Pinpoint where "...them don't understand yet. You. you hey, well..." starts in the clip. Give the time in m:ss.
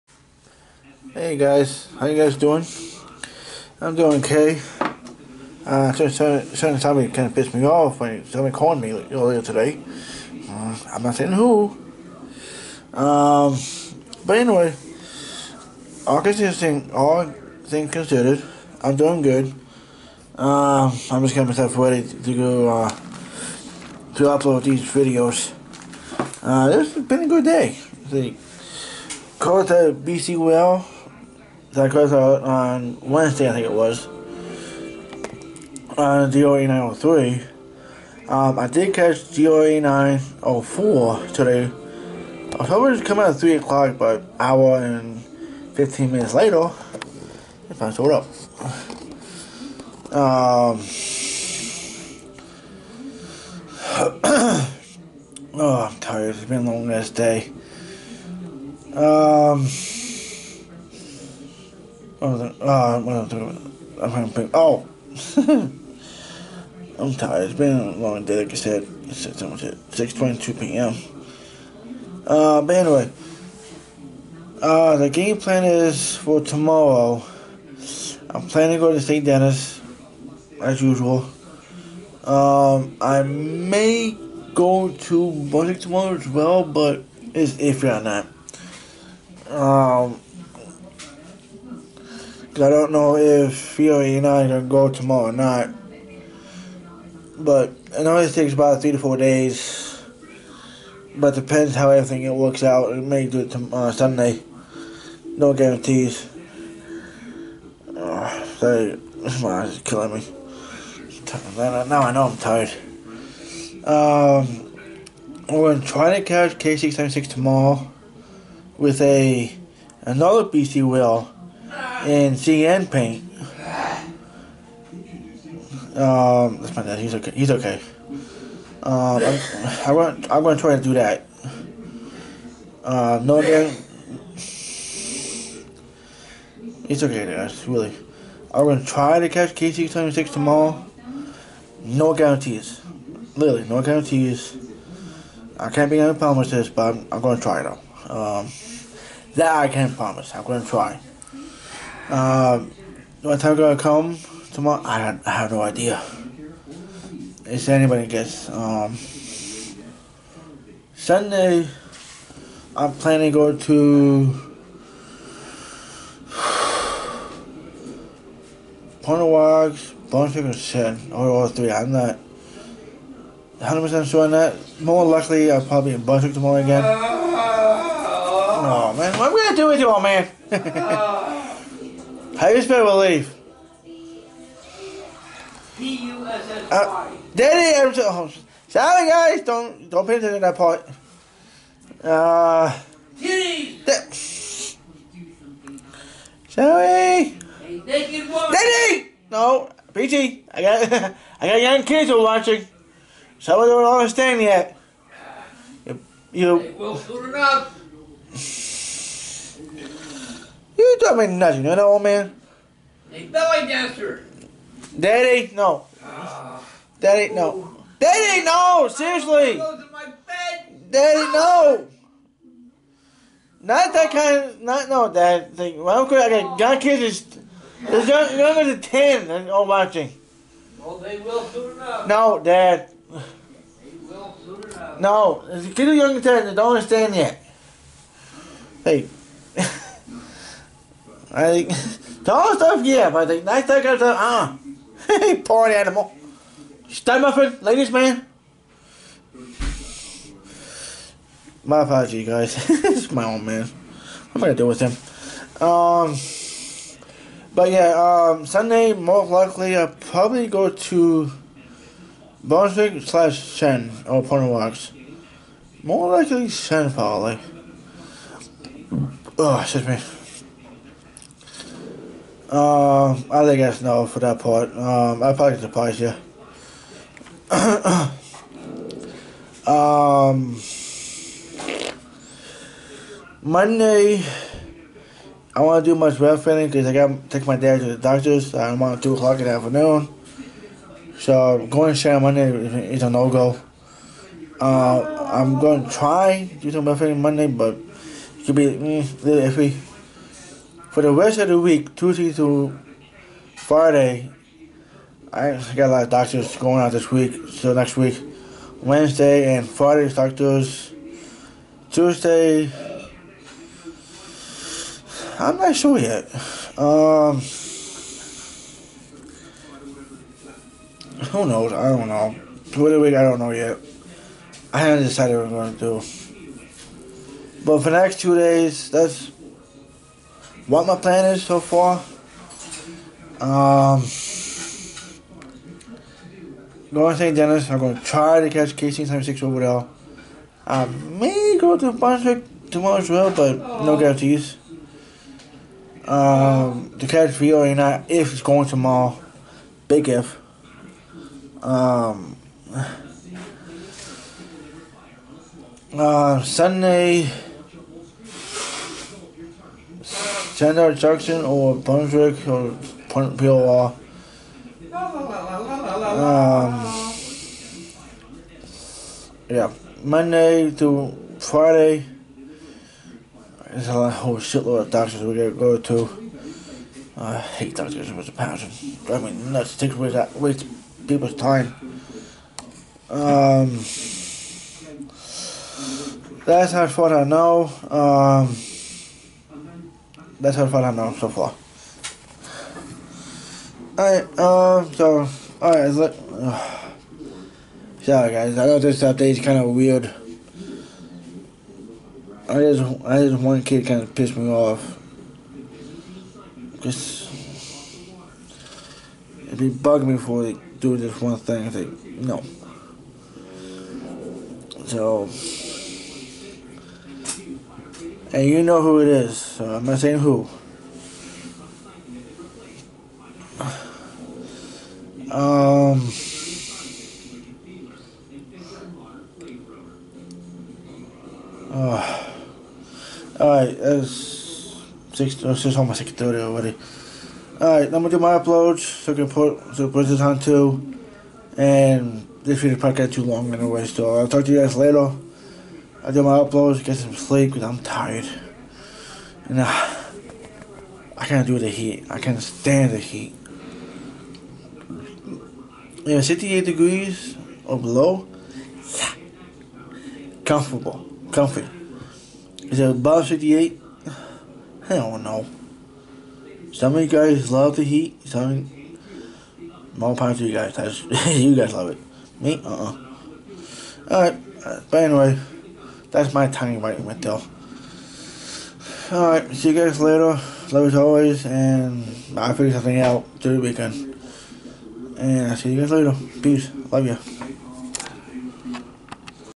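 3:23.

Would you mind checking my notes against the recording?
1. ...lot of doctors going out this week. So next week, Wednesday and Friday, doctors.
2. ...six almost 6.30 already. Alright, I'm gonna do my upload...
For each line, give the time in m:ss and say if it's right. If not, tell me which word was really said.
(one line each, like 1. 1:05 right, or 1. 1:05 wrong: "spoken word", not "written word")
1. 5:05 right
2. 7:15 right.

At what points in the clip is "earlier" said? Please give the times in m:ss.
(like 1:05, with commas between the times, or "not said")
0:09.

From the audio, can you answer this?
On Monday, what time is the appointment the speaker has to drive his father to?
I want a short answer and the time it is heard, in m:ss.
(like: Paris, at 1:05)
2 o'clock, at 4:49.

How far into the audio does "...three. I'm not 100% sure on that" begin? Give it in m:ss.
2:51.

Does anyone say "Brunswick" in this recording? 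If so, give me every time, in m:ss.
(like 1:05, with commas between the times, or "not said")
4:22, 5:41, 6:01.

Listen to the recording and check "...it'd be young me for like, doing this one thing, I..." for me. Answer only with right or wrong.
wrong.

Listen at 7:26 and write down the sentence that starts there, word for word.
I do my uploads, get some sleep because I'm tired.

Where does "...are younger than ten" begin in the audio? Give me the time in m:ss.
3:55.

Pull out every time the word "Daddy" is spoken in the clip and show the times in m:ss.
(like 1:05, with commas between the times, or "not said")
3:07, 3:18.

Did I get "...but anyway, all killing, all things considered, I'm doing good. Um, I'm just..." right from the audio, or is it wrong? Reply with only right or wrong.
wrong.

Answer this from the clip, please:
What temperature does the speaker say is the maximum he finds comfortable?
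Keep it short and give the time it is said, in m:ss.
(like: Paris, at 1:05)
68 degrees, at 7:36.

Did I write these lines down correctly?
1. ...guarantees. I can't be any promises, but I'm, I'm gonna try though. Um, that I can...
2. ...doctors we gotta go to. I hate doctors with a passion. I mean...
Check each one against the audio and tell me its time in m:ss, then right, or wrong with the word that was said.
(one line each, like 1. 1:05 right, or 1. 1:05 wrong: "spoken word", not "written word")
1. 2:23 right
2. 6:14 right.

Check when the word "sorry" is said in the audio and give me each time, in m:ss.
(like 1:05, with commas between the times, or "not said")
3:08, 3:16, 6:38.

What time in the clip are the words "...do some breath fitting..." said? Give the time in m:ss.
4:56.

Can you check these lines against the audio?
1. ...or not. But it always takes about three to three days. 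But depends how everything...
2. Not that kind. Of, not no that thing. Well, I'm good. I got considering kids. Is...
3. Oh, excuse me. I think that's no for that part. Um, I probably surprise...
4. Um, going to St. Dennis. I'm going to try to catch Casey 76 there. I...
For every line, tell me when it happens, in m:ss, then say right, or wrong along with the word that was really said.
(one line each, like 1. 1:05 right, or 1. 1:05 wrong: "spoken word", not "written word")
1. 1:35 wrong: "four", not "three"
2. 3:43 wrong: "young", not "considering"
3. 4:29 right
4. 5:33 right.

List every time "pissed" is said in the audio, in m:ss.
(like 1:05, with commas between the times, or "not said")
0:07, 6:44.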